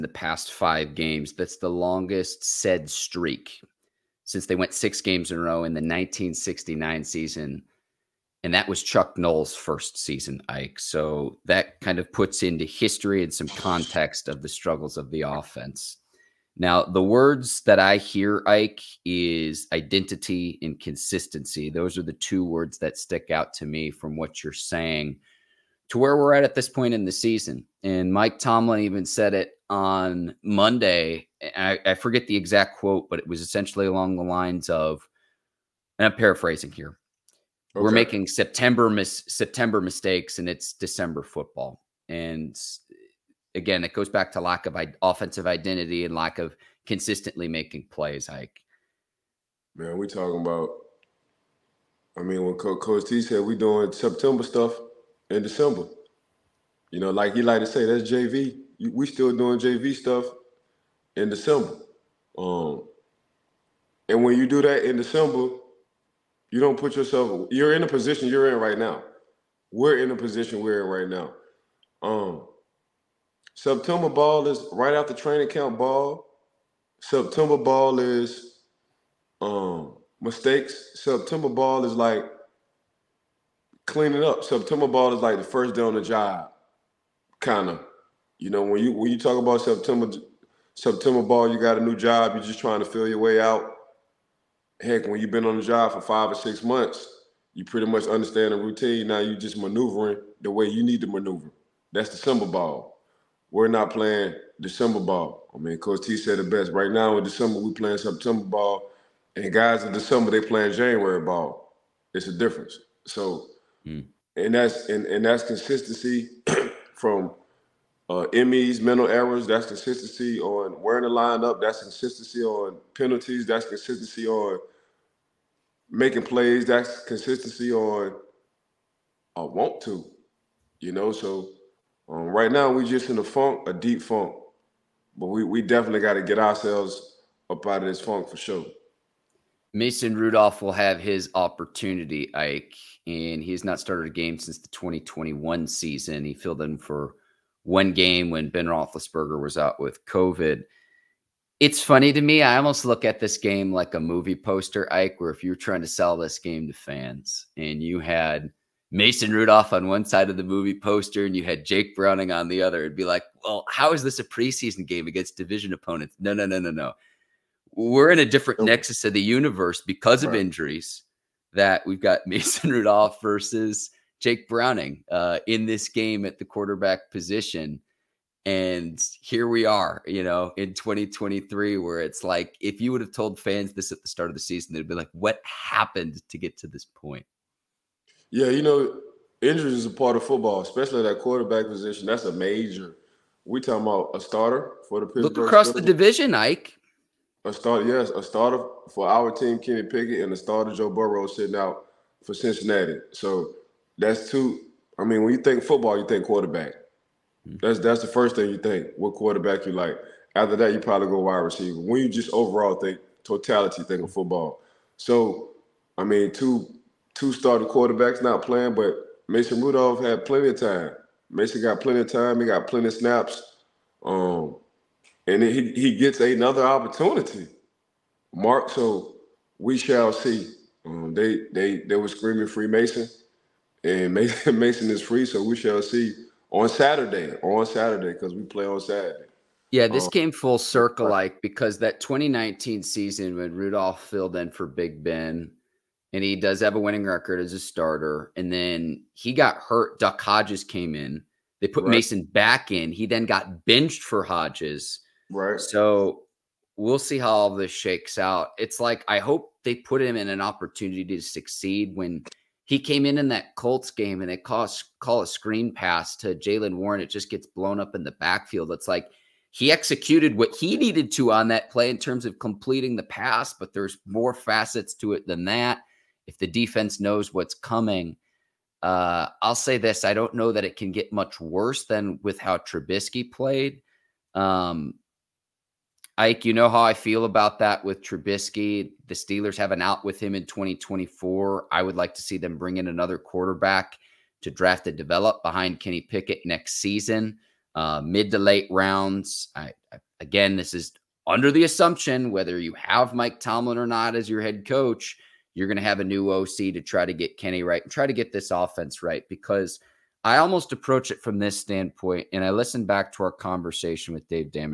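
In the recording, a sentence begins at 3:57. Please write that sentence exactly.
On Saturday, because we play on Saturday.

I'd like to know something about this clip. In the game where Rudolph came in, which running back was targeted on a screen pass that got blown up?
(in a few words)
Jaylen Warren.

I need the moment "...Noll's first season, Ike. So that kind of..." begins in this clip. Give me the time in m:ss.
0:09.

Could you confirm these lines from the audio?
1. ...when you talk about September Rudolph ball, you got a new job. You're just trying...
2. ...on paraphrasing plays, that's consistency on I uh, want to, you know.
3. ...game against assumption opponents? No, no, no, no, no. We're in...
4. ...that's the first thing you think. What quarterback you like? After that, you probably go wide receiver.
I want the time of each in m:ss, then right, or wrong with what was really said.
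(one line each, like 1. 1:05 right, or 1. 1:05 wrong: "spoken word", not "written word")
1. 1:28 wrong: "September", not "Rudolph"
2. 2:04 wrong: "making", not "paraphrasing"
3. 2:44 wrong: "division", not "assumption"
4. 3:27 right.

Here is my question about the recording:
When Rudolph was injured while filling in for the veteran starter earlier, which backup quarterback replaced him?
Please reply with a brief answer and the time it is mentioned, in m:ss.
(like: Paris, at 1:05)
Duck Hodges, at 4:09.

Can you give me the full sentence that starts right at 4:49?
The Steelers have an out with him in 2024.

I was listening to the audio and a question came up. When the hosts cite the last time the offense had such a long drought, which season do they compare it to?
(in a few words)
1969.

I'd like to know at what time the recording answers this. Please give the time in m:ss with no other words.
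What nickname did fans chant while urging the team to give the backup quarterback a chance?
3:52.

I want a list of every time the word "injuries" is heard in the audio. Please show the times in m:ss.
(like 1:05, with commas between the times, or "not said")
2:50, 3:09.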